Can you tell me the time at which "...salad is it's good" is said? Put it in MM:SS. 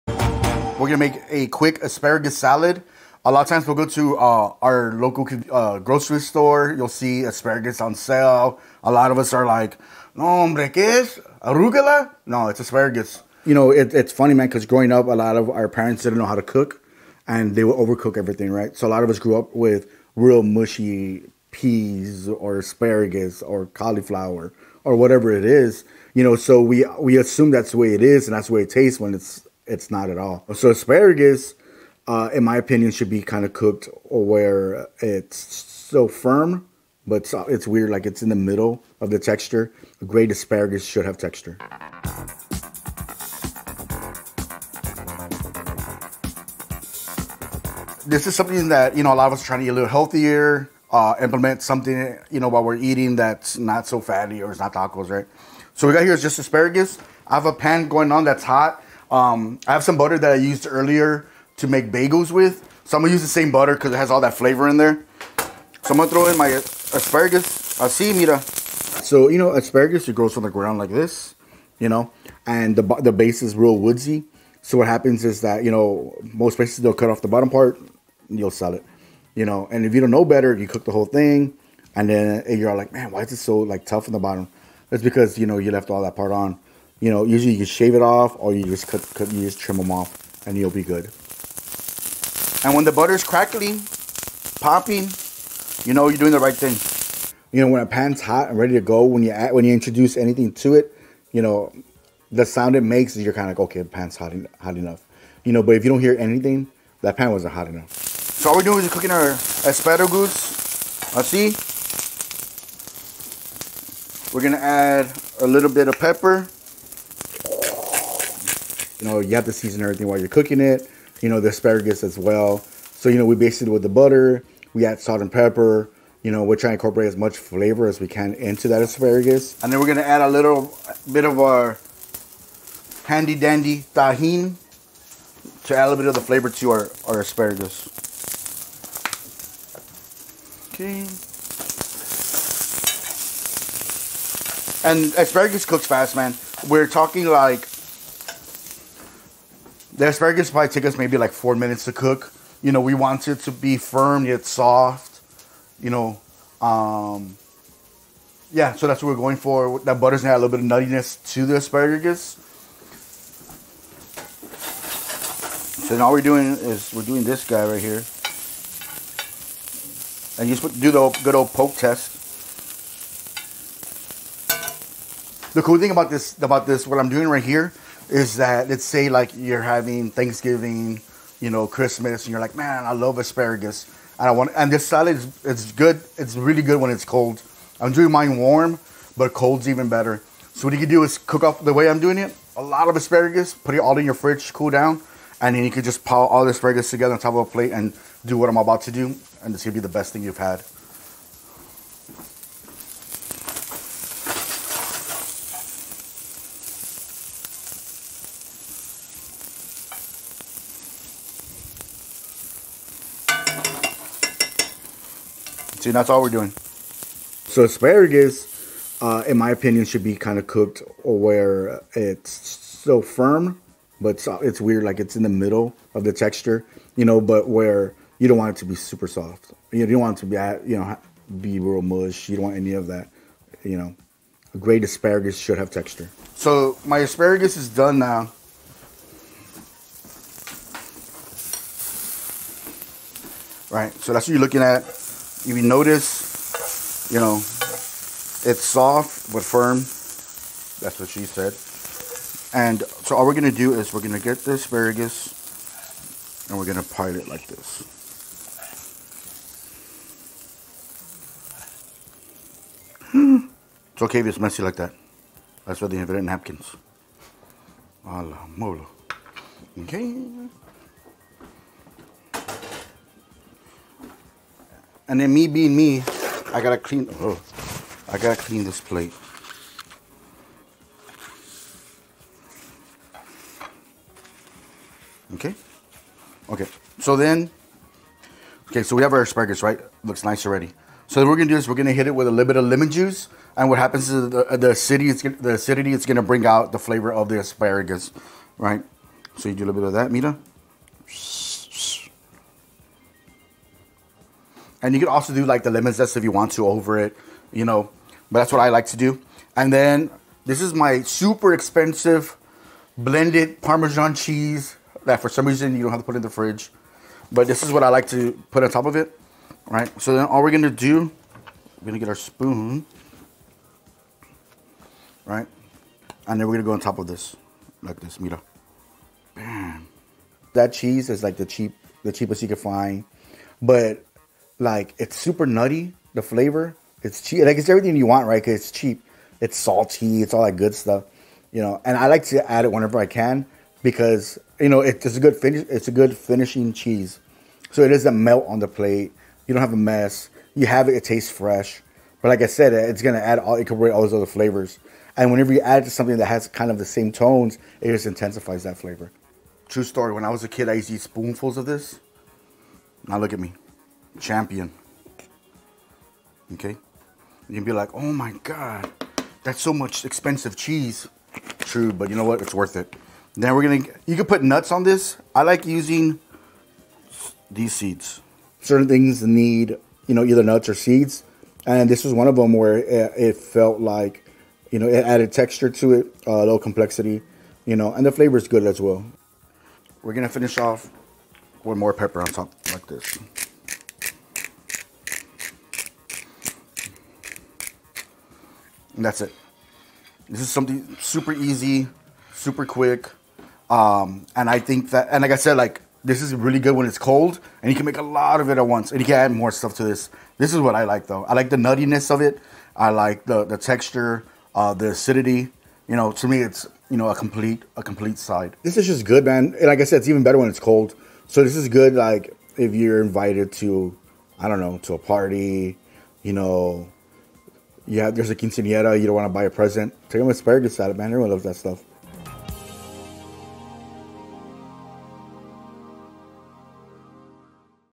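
03:04.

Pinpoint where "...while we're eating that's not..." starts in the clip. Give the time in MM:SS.
00:52.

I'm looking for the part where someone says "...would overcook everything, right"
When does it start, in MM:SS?
00:17.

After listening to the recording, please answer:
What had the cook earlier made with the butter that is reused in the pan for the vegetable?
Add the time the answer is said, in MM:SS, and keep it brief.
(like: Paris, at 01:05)
bagels, at 01:01.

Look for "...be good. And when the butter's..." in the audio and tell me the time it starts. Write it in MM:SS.
01:30.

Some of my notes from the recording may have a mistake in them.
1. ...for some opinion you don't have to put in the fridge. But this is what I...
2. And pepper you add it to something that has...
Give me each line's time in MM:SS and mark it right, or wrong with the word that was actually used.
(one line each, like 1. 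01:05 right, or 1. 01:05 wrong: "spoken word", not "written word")
1. 05:15 wrong: "reason", not "opinion"
2. 05:55 wrong: "whenever", not "pepper".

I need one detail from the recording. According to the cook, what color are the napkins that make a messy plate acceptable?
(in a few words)
red.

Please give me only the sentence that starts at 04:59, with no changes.
So you do a little bit of that, Mita.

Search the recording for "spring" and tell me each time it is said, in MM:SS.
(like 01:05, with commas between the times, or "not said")
not said.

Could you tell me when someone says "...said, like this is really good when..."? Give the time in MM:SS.
06:45.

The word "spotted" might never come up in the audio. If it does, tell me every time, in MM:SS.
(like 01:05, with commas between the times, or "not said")
not said.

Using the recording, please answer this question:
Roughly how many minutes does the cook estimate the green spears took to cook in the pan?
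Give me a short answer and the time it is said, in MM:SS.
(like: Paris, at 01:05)
4, at 02:31.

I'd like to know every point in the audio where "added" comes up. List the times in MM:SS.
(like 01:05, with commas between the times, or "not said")
06:25.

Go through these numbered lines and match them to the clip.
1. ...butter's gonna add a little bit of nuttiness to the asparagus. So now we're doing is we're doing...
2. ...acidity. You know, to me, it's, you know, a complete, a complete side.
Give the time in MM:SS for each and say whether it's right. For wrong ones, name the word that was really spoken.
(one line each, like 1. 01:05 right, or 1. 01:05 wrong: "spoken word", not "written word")
1. 02:40 right
2. 06:54 right.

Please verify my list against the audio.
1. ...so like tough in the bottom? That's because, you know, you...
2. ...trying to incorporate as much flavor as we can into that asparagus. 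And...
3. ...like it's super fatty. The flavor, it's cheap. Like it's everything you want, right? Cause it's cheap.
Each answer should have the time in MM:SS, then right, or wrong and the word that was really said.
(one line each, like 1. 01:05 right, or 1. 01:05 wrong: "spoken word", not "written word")
1. 01:23 right
2. 02:06 right
3. 05:34 wrong: "nutty", not "fatty".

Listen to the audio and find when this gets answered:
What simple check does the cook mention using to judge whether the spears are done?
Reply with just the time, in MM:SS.
02:50.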